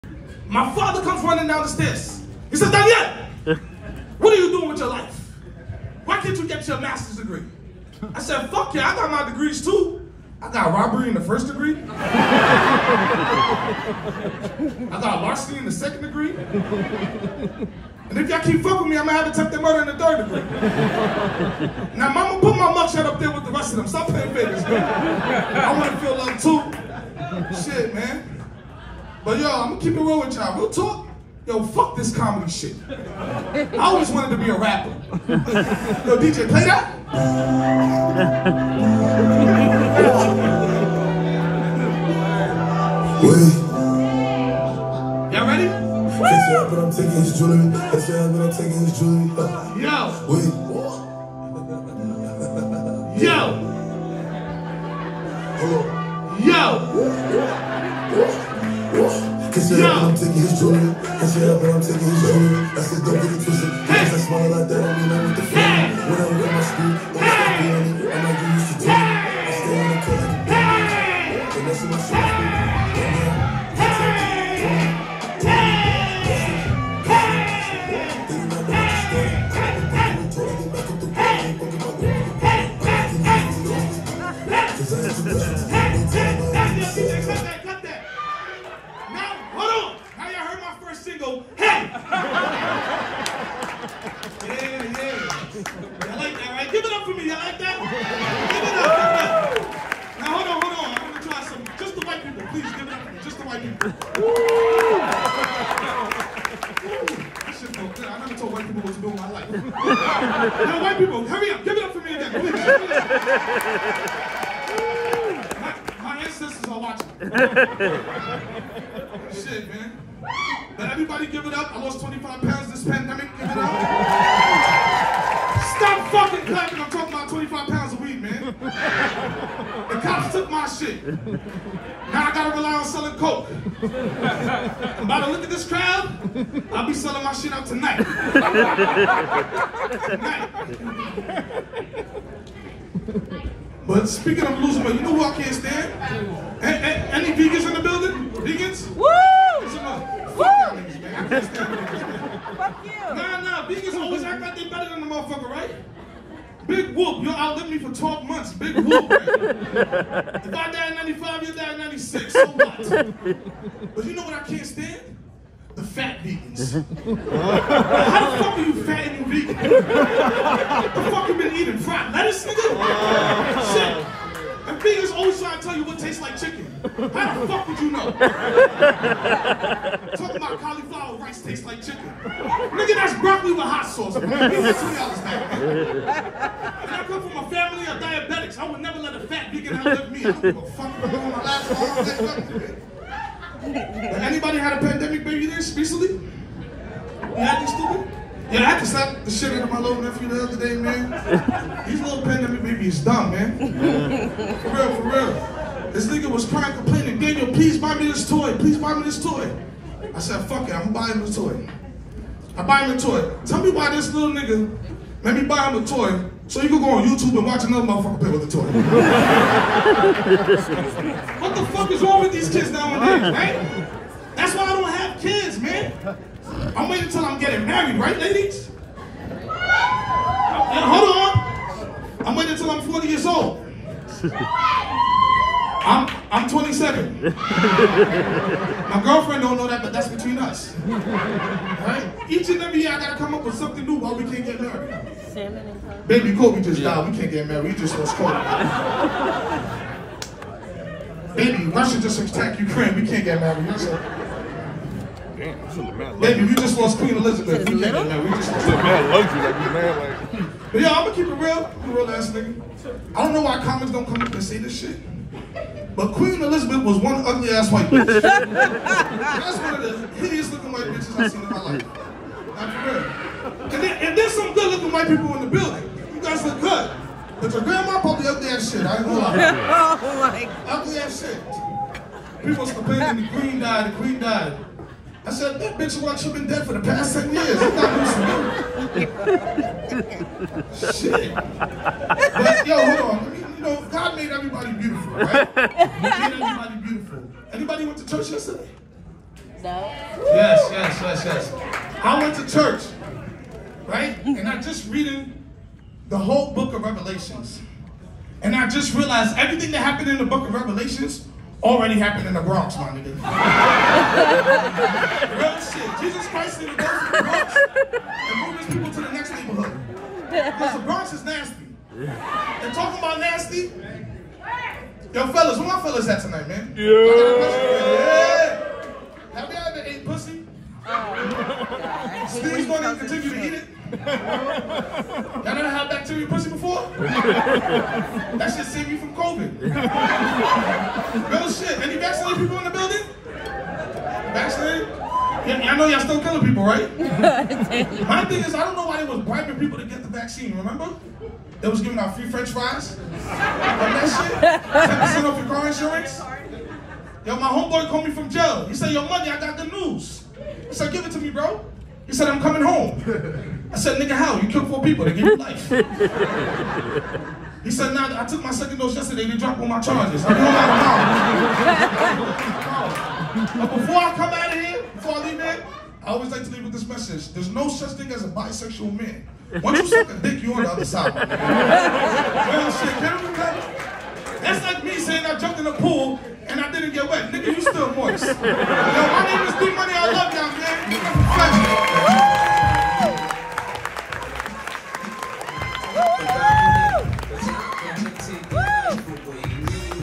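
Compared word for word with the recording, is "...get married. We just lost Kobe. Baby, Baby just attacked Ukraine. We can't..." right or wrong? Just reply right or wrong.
wrong.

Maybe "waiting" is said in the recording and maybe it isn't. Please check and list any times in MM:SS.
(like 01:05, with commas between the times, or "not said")
03:46, 03:52.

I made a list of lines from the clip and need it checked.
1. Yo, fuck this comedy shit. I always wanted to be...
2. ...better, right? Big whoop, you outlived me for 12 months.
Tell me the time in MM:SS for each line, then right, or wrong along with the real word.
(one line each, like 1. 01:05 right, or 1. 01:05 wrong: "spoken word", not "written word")
1. 00:31 right
2. 02:35 wrong: "motherfucker", not "better".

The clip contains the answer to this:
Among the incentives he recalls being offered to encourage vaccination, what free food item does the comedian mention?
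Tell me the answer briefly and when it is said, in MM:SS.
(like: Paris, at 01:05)
French fries, at 05:52.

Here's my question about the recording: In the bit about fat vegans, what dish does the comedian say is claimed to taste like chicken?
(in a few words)
Cauliflower rice.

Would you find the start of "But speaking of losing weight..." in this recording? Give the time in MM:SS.
02:23.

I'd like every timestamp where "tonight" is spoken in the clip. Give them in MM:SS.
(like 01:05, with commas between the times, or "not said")
02:17, 05:26.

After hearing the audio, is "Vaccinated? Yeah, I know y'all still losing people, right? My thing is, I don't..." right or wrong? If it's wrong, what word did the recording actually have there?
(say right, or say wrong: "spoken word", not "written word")
wrong: "killing", not "losing".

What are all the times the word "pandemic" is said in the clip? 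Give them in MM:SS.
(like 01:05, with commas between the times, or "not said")
02:02, 03:14, 03:22.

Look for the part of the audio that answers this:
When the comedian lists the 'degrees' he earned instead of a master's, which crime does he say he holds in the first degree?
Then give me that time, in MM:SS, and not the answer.
00:10.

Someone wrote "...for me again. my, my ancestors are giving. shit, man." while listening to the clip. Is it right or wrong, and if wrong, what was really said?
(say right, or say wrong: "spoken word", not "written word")
wrong: "watching", not "giving".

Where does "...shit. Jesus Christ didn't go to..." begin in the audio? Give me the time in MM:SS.
05:15.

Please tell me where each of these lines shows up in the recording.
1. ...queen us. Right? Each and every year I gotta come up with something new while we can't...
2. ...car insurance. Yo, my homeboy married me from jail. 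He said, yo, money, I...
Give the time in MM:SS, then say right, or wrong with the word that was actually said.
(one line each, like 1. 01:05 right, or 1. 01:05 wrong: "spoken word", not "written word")
1. 04:00 wrong: "between", not "queen"
2. 05:55 wrong: "called", not "married".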